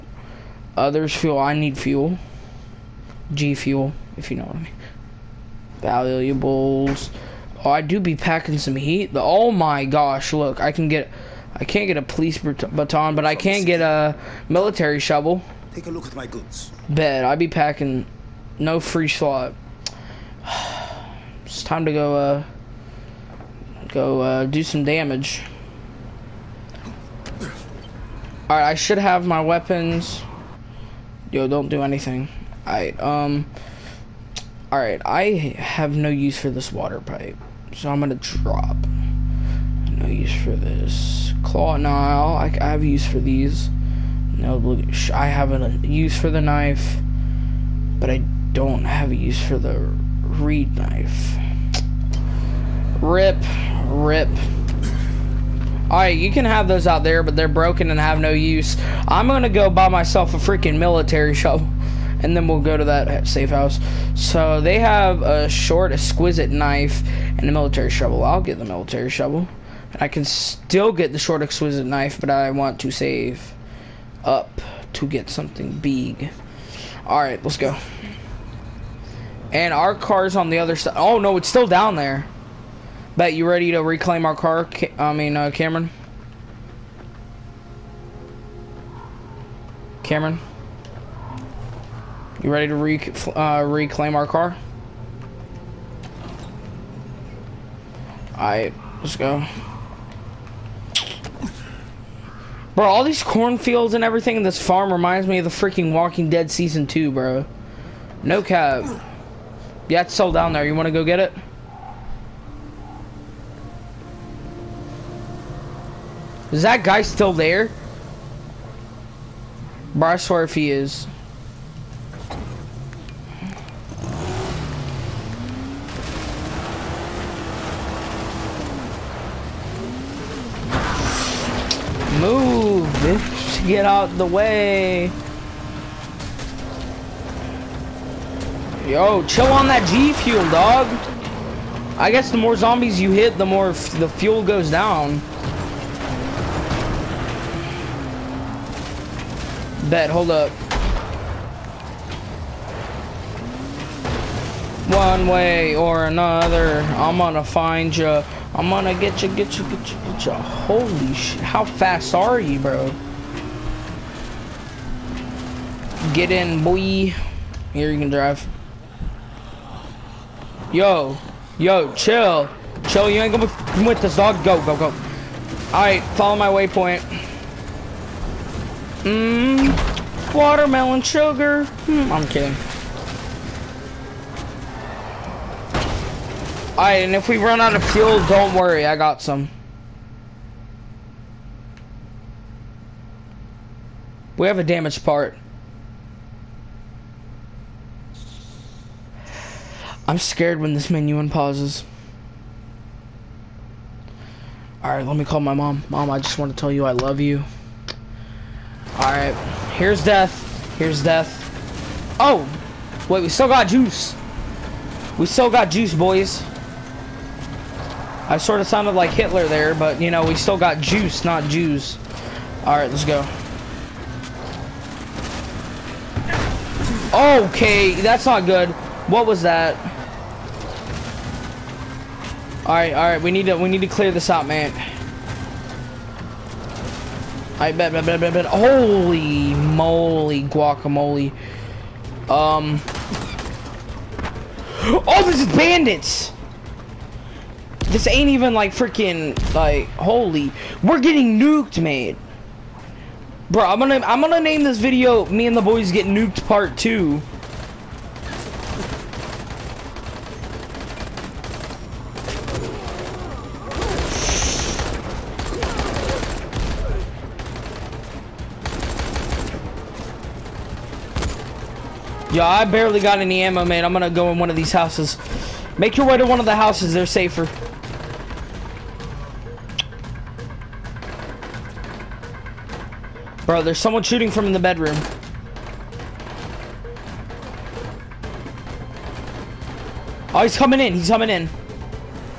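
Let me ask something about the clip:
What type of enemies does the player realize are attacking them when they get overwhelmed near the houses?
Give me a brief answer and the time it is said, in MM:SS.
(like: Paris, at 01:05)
Bandits, at 04:05.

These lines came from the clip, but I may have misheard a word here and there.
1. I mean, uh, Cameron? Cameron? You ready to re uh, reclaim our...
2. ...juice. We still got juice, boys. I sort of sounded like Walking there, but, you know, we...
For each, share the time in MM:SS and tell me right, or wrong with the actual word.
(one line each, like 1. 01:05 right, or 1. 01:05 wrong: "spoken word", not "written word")
1. 01:24 right
2. 03:33 wrong: "Hitler", not "Walking".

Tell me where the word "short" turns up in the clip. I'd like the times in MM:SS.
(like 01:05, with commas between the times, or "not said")
01:05, 01:11.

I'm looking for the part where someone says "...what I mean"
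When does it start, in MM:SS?
00:04.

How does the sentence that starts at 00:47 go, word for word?
But I don't have a use for the reed knife.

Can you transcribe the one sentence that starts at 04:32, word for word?
Yo, I barely got any ammo, man.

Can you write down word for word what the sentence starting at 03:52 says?
Alright, alright, we need to we need to clear this out, man.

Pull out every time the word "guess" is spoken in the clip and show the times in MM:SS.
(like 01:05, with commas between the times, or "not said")
02:22.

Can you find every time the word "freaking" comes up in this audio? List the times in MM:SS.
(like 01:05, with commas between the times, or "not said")
01:00, 01:45, 04:08.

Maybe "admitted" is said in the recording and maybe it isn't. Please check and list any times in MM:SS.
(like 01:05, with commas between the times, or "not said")
not said.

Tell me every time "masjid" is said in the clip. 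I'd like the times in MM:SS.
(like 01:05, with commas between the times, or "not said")
not said.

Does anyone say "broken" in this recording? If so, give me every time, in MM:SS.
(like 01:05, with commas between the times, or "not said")
00:57.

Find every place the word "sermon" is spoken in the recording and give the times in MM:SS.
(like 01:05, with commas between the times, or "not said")
not said.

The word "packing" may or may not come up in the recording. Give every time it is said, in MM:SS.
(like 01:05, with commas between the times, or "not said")
00:08, 00:17.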